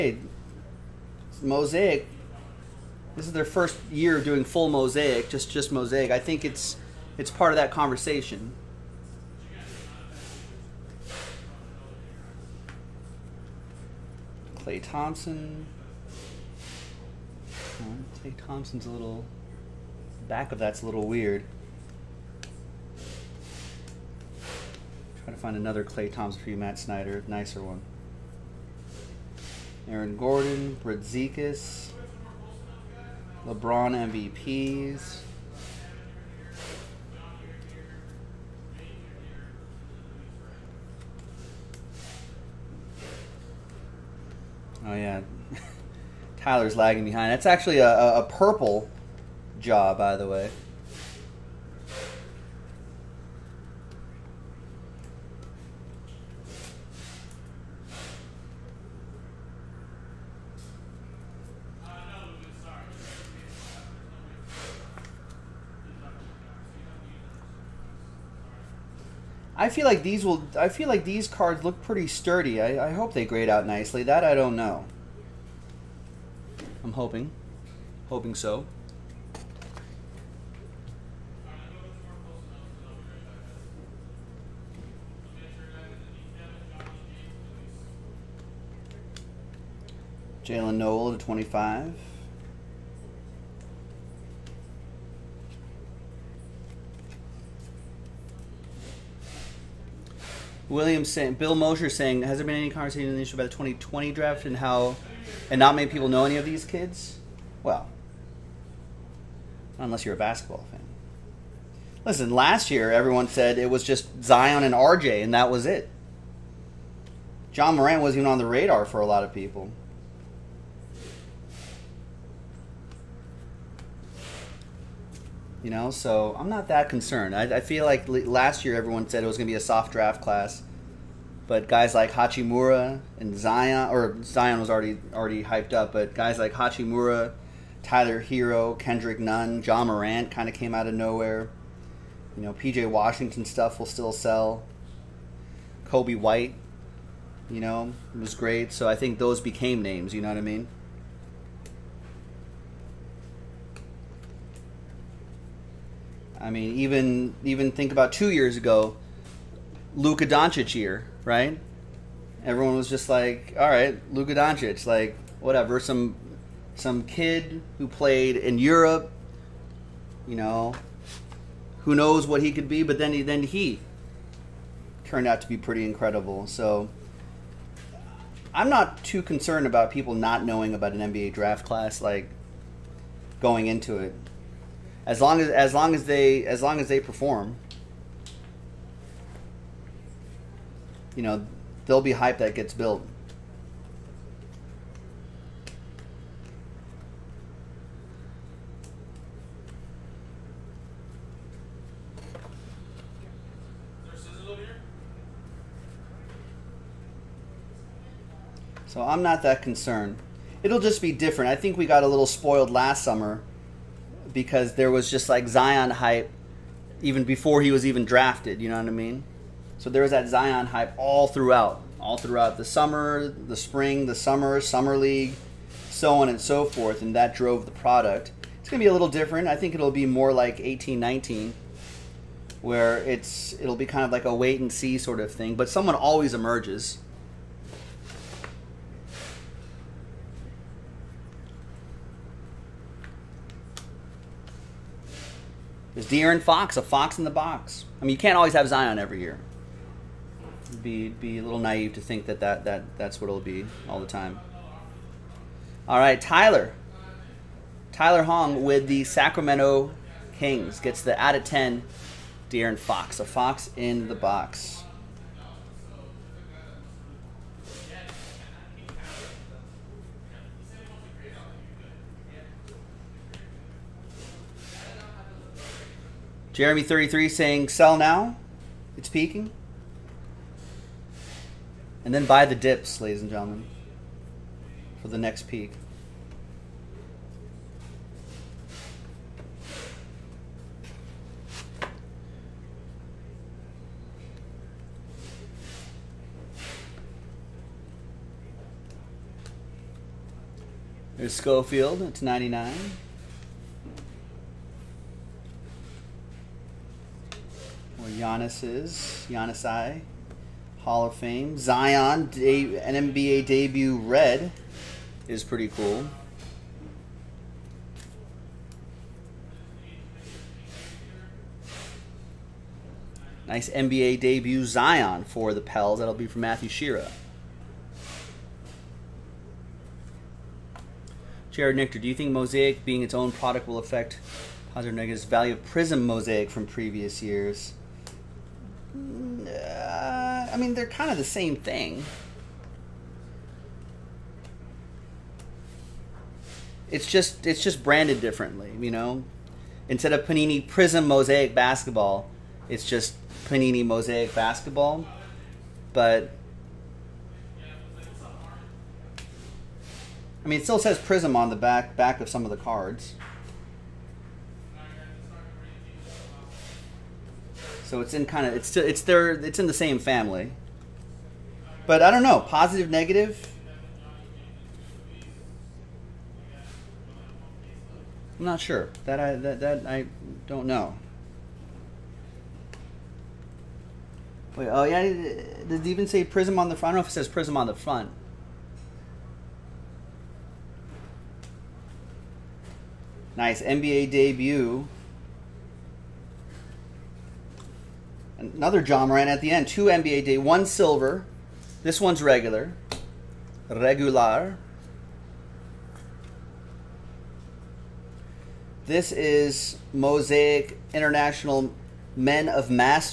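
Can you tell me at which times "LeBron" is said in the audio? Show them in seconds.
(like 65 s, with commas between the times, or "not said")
33 s.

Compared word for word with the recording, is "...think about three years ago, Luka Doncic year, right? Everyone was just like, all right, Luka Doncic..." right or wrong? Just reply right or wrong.
wrong.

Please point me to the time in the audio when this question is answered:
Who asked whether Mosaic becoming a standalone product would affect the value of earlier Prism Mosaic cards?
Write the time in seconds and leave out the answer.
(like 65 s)
331 s.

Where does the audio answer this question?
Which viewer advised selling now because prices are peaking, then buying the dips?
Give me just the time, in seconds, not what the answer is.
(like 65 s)
276 s.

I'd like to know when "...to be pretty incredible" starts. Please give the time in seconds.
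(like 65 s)
175 s.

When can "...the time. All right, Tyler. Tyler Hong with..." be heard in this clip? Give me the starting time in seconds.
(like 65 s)
253 s.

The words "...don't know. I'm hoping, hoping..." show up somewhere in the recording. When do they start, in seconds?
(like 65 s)
74 s.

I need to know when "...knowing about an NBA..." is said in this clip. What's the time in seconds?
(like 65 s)
180 s.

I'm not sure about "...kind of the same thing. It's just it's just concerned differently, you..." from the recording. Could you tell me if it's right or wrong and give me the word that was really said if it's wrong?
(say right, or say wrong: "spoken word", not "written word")
wrong: "branded", not "concerned".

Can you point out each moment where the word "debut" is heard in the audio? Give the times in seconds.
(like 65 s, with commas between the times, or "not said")
313 s, 324 s, 394 s.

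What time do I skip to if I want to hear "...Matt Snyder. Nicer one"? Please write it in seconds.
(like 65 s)
26 s.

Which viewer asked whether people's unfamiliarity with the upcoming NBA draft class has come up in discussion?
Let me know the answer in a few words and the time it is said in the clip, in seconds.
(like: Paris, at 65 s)
Bill Mosher, at 101 s.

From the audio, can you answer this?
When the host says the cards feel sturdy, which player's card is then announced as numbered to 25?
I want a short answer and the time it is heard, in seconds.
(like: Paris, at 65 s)
Jalen Noel, at 90 s.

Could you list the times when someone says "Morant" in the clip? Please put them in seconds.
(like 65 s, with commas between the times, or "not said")
117 s, 139 s, 399 s.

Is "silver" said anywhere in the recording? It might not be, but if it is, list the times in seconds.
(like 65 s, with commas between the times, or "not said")
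400 s.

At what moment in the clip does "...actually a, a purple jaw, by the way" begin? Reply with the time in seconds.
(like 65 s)
47 s.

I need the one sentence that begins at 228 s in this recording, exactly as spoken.
It's gonna be a little different.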